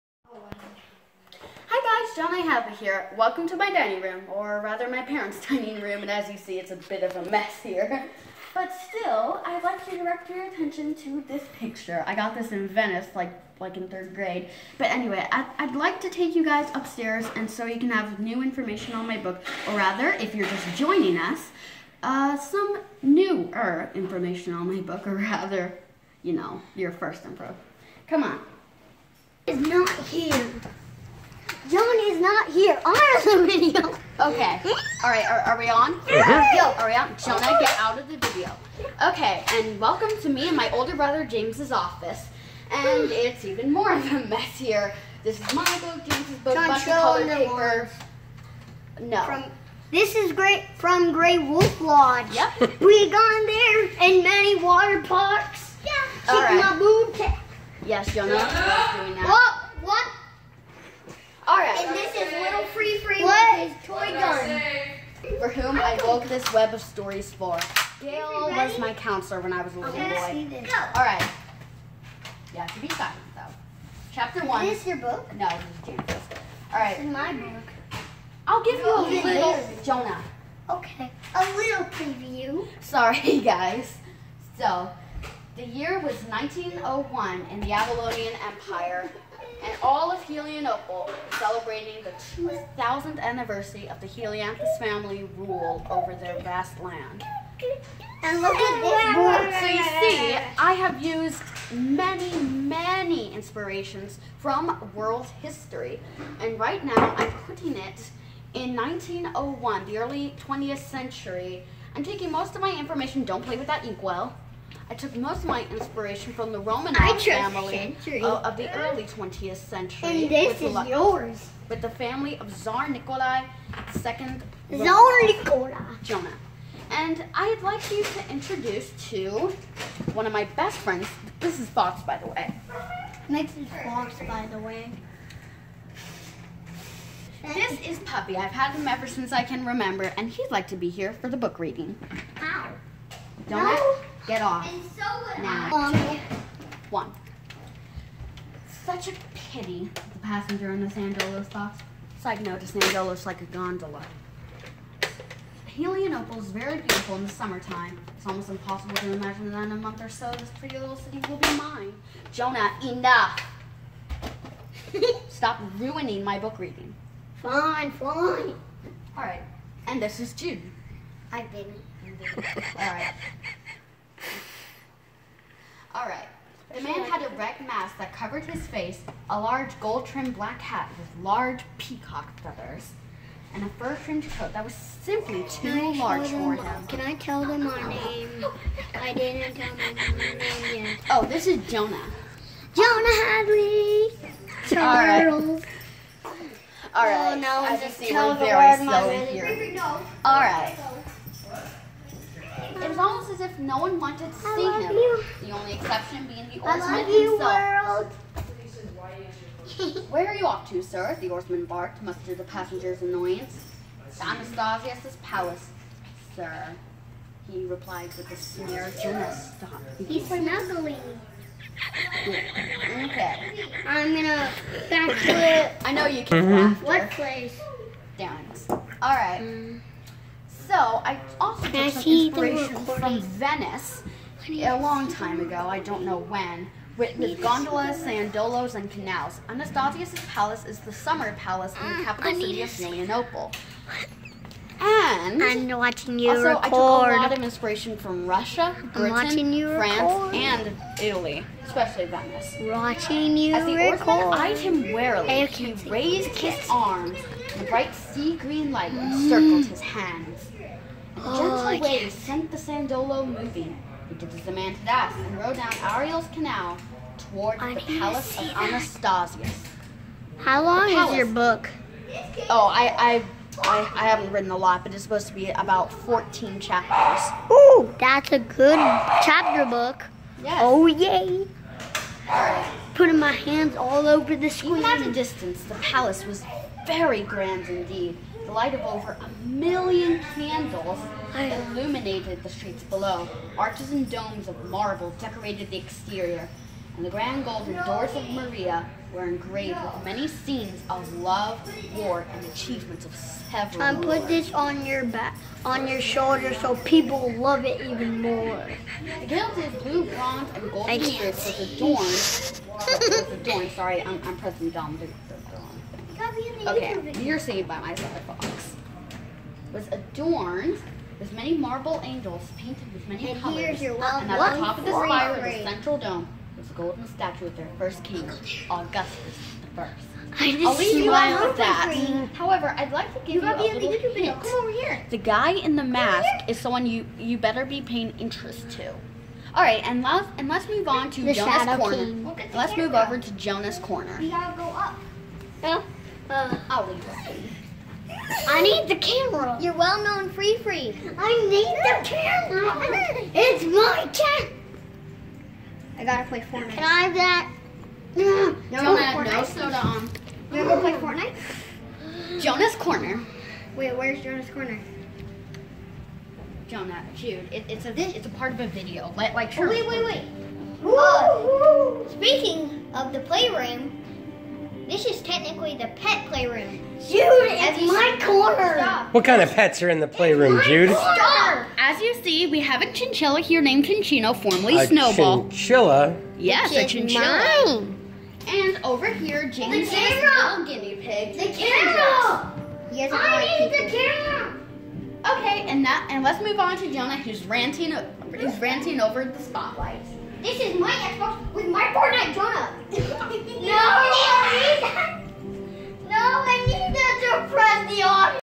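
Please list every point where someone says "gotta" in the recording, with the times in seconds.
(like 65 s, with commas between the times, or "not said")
344 s, 356 s.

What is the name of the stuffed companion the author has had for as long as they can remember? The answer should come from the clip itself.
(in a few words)
Puppy.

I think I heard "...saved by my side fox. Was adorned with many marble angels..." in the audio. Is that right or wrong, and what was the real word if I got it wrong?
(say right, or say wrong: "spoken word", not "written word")
right.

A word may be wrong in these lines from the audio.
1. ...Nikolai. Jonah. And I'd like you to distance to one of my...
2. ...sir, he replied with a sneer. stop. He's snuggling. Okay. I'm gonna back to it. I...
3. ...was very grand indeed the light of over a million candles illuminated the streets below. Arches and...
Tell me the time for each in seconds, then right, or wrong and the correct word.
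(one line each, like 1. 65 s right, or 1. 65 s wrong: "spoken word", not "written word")
1. 125 s wrong: "introduce", not "distance"
2. 216 s right
3. 286 s right.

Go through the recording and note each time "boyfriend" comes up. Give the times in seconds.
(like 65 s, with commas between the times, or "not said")
not said.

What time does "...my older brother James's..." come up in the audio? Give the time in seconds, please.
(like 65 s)
40 s.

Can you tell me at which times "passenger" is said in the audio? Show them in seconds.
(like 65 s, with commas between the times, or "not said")
150 s, 212 s.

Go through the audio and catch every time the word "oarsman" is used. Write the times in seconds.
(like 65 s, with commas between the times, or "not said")
206 s, 211 s, 254 s.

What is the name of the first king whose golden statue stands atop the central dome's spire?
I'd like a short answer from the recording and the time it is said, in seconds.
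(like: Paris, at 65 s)
Augustus the First, at 328 s.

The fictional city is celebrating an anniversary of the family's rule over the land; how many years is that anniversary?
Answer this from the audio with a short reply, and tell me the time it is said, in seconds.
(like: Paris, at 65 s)
2000, at 92 s.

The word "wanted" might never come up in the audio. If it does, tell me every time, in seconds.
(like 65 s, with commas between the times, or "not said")
203 s.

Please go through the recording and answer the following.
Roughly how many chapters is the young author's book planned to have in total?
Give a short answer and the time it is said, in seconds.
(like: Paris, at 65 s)
14, at 275 s.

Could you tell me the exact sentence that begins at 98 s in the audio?
And look at this So you see, I have used many, many inspirations from world history.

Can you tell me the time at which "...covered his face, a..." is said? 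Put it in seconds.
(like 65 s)
178 s.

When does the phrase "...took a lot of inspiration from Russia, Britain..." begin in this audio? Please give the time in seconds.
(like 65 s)
246 s.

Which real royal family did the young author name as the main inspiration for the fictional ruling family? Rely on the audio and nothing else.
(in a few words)
Romanov.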